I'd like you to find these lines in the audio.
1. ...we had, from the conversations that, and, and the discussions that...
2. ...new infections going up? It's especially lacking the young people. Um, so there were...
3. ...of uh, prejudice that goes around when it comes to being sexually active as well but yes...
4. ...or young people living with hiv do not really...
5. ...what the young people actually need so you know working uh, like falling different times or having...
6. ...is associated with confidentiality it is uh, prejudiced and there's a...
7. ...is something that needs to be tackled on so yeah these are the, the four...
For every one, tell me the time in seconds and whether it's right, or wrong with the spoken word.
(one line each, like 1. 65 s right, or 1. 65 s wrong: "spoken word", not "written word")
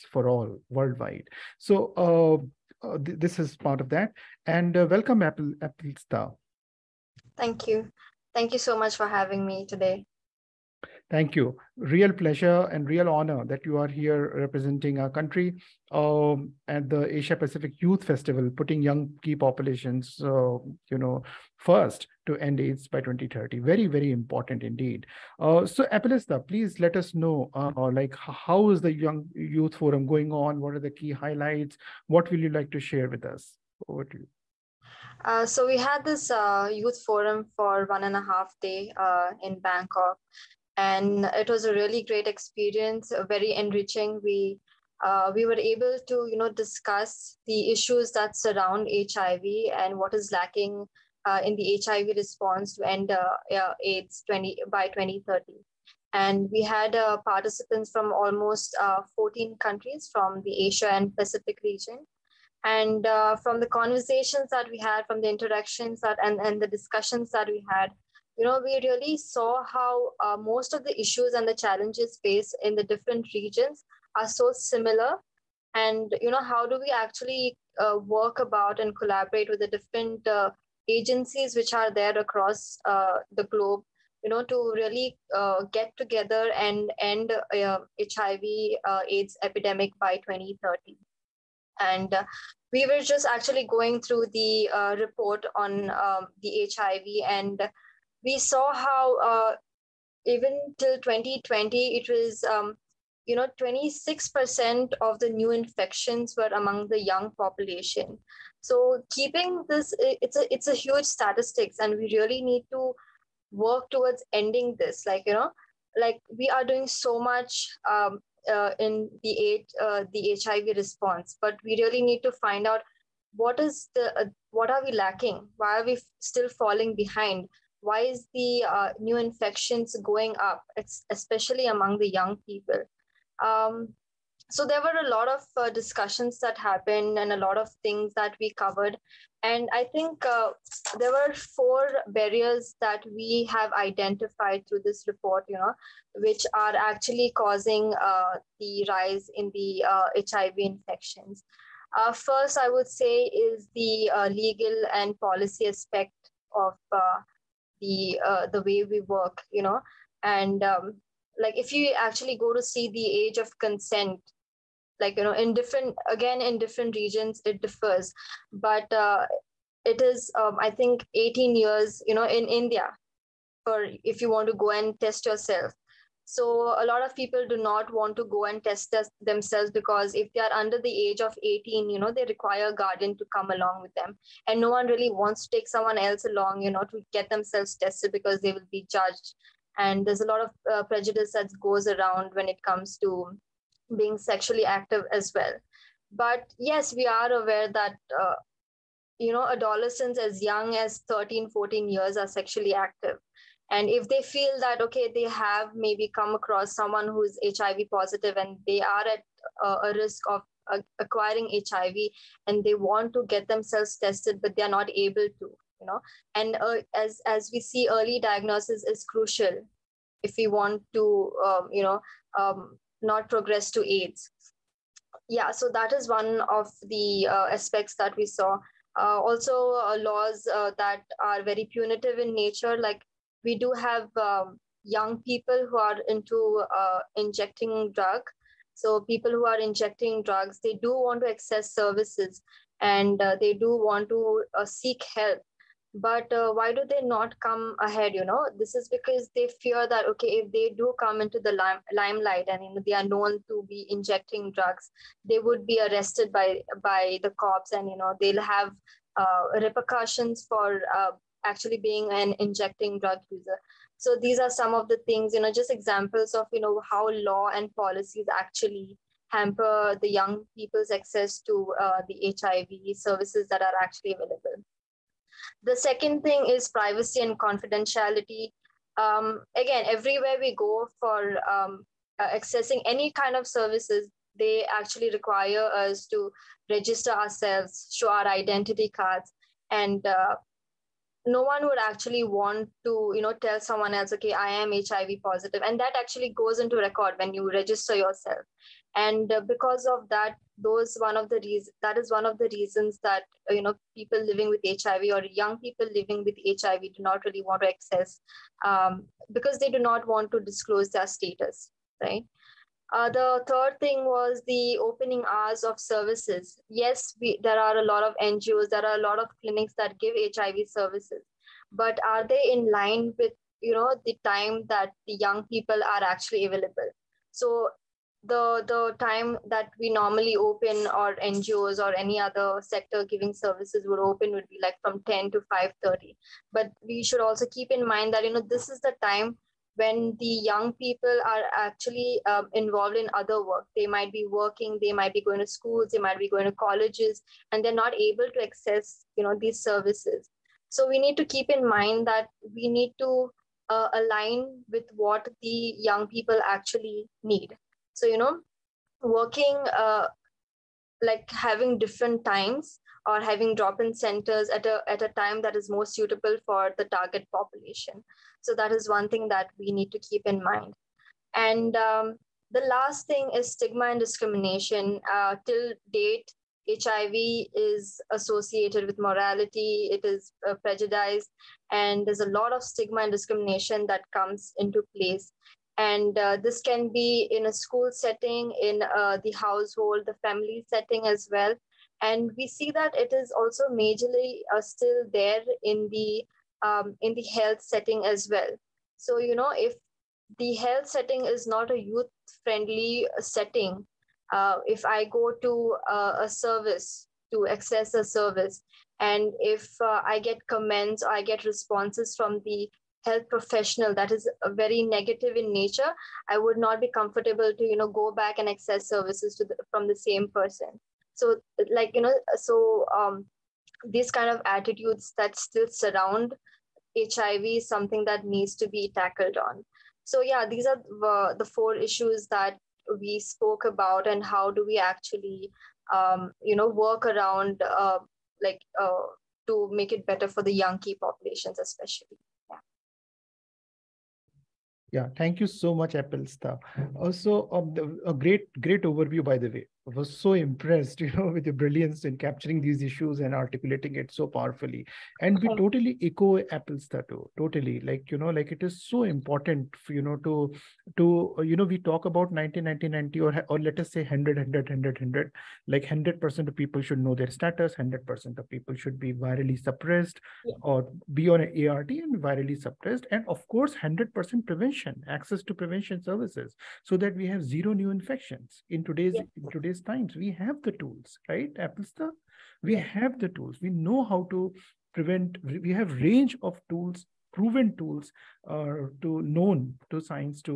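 1. 64 s wrong: "interactions", not "conversations"
2. 128 s wrong: "among", not "lacking"
3. 190 s right
4. 305 s right
5. 354 s wrong: "having", not "falling"
6. 377 s wrong: "morality", not "confidentiality"
7. 427 s right.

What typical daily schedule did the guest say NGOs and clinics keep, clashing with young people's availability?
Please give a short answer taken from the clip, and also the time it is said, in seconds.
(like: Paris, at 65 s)
10 to 5:30, at 335 s.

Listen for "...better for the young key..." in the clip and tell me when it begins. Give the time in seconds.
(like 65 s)
440 s.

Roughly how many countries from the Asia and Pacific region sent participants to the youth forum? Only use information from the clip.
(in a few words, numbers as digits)
14.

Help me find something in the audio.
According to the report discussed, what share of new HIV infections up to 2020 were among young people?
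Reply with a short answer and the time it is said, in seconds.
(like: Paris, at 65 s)
26%, at 103 s.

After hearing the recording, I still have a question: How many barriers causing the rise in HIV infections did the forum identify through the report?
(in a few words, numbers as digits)
4.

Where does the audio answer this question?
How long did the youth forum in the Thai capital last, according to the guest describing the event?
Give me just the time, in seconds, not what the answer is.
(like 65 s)
37 s.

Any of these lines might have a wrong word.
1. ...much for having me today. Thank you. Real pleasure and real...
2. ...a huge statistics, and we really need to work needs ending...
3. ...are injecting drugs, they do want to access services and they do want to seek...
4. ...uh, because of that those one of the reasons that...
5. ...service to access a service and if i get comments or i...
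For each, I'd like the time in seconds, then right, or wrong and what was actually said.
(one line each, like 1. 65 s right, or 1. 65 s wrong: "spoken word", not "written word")
1. 8 s right
2. 110 s wrong: "towards", not "needs"
3. 239 s right
4. 299 s right
5. 406 s right.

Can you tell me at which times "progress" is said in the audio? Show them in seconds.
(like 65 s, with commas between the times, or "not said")
223 s.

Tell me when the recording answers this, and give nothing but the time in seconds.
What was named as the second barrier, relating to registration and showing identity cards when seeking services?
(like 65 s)
276 s.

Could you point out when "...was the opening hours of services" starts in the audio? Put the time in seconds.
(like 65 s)
314 s.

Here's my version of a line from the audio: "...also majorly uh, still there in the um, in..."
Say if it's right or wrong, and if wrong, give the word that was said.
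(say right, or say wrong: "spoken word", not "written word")
right.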